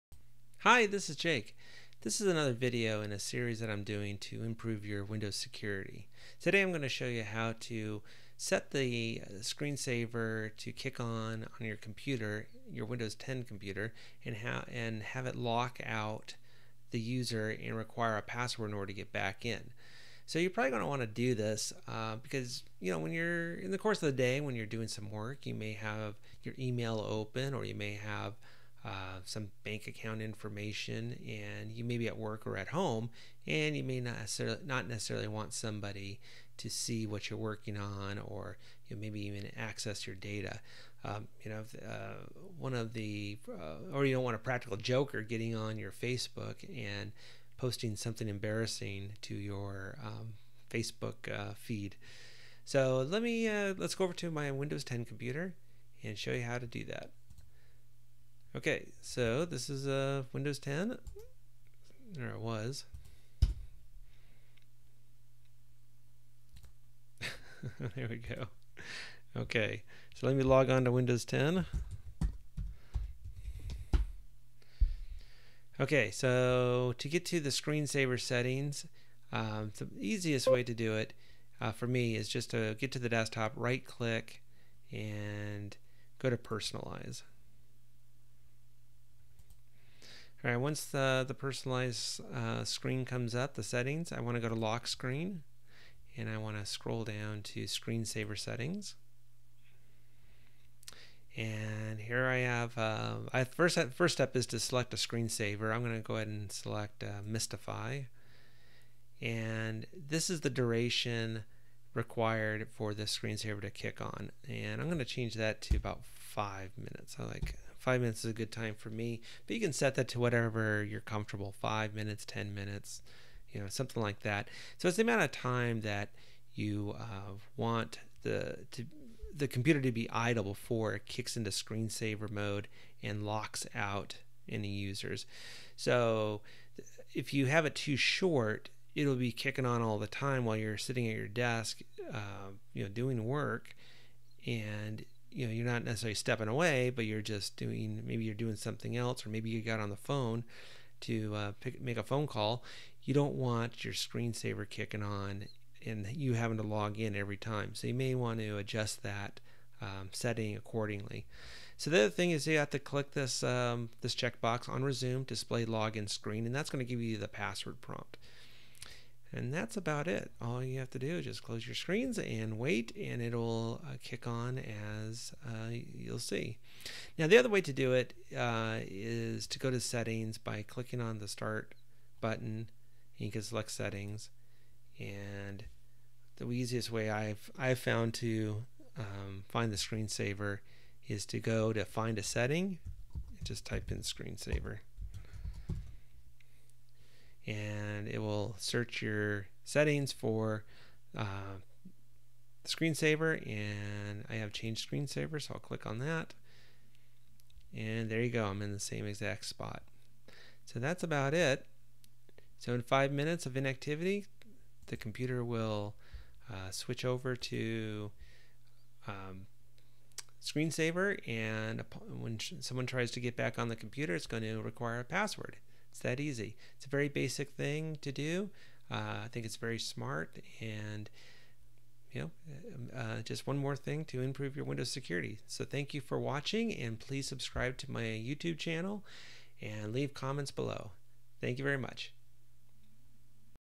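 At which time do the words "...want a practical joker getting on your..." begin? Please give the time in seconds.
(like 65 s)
44 s.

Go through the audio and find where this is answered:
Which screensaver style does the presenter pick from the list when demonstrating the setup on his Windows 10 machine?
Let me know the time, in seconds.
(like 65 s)
107 s.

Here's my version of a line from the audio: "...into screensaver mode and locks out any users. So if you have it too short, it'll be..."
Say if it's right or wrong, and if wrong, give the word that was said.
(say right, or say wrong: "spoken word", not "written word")
right.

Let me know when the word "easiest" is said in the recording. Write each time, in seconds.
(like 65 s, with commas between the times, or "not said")
79 s, 186 s.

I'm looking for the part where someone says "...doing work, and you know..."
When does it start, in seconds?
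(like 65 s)
142 s.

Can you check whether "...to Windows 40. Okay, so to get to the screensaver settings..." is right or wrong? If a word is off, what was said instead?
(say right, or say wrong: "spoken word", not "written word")
wrong: "10", not "40".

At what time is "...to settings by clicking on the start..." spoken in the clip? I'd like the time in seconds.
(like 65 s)
179 s.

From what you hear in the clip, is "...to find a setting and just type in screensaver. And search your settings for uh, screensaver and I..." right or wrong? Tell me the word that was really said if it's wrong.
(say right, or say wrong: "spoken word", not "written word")
right.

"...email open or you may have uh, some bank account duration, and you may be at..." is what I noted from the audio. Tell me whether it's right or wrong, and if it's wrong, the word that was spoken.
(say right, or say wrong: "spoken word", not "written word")
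wrong: "information", not "duration".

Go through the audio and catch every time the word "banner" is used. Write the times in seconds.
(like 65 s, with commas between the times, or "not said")
not said.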